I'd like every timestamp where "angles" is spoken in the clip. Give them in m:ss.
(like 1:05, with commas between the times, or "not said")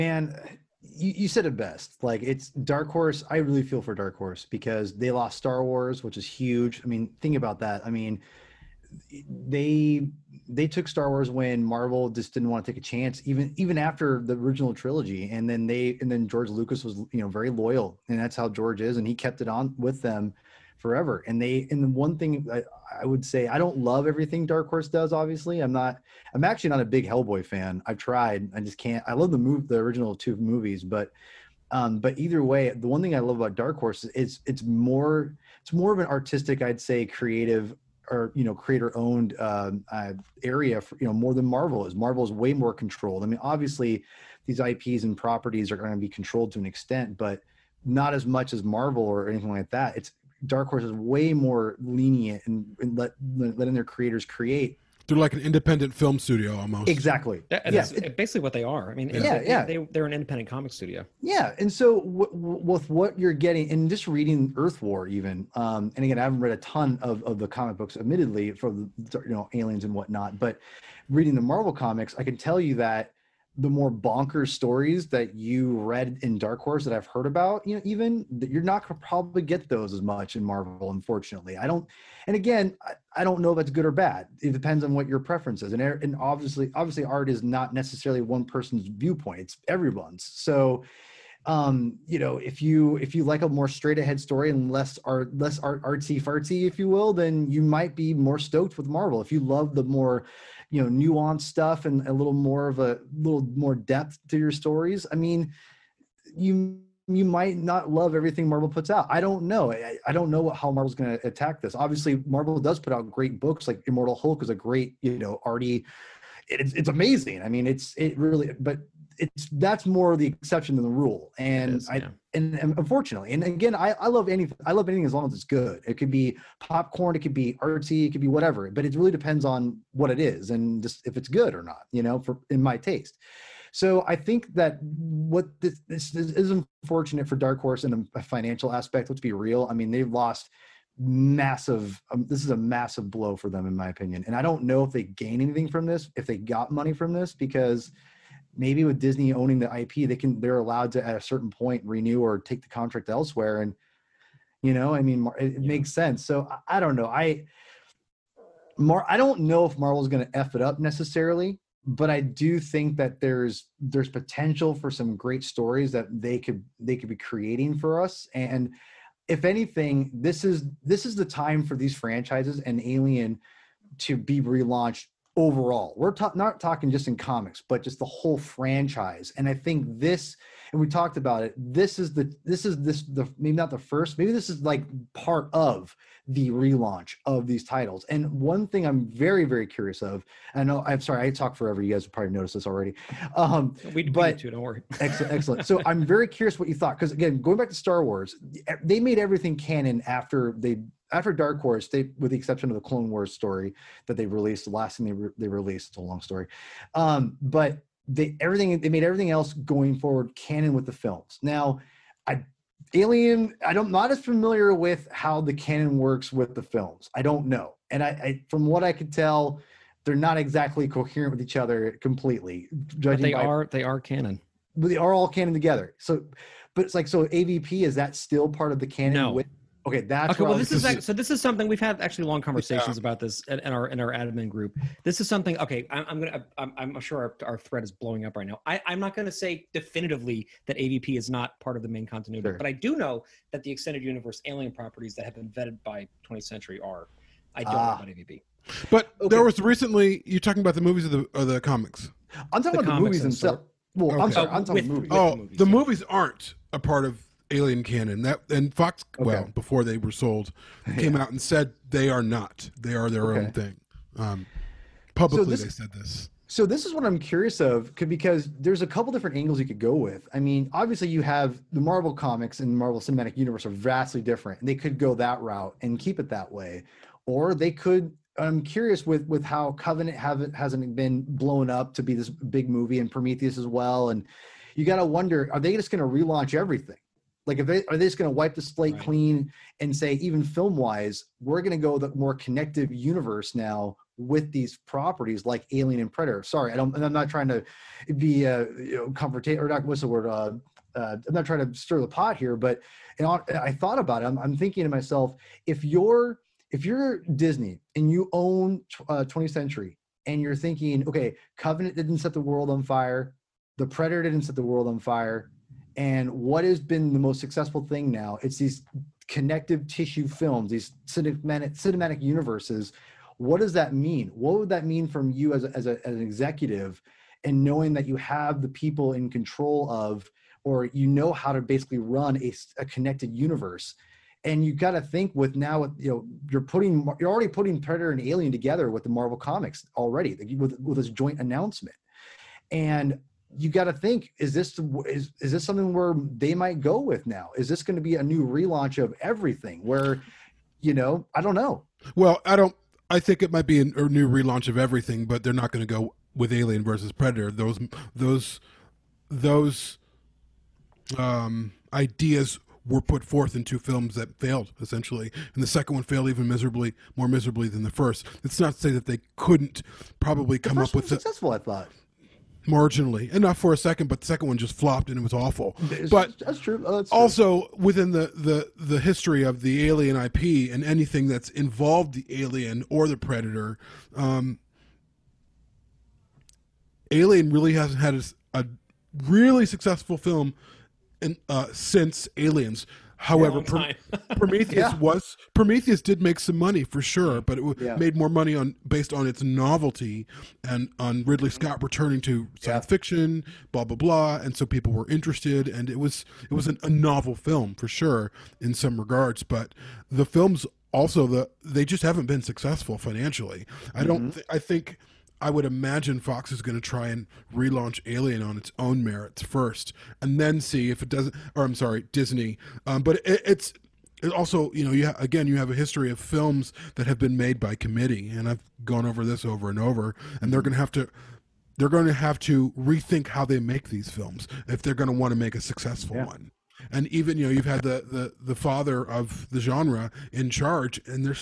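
4:29.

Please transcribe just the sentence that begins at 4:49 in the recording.
clean and say, even film wise, we're going to go the more connective universe now with these properties like Alien and Predator.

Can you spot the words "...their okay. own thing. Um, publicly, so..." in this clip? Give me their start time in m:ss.
4:23.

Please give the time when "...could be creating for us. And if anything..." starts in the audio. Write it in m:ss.
2:46.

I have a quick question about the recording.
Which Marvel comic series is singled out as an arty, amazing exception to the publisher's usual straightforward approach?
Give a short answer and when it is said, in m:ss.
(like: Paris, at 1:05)
Immortal Hulk, at 1:53.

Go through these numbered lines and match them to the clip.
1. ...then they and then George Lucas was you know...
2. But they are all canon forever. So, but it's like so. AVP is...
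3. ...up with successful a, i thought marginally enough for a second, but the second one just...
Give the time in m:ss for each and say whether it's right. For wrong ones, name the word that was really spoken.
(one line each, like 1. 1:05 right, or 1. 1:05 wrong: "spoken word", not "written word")
1. 0:15 right
2. 3:44 wrong: "together", not "forever"
3. 6:10 right.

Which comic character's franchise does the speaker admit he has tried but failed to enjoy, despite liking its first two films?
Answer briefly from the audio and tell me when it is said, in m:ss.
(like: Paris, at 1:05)
Hellboy, at 0:27.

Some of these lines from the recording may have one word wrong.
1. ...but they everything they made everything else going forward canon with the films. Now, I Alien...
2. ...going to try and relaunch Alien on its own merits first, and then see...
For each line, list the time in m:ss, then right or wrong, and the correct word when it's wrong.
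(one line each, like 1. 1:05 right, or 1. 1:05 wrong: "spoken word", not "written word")
1. 3:27 right
2. 6:56 right.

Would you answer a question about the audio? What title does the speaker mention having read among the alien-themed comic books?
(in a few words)
Earth War.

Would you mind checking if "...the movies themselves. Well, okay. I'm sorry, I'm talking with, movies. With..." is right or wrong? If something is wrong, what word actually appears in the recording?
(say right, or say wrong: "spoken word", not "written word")
right.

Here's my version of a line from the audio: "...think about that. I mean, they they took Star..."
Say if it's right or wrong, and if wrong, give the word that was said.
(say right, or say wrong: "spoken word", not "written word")
right.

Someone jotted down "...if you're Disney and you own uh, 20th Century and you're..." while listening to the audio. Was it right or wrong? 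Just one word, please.
right.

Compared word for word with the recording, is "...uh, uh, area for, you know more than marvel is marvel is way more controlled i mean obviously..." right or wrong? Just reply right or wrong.
right.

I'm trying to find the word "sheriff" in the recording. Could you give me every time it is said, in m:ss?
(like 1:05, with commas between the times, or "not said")
not said.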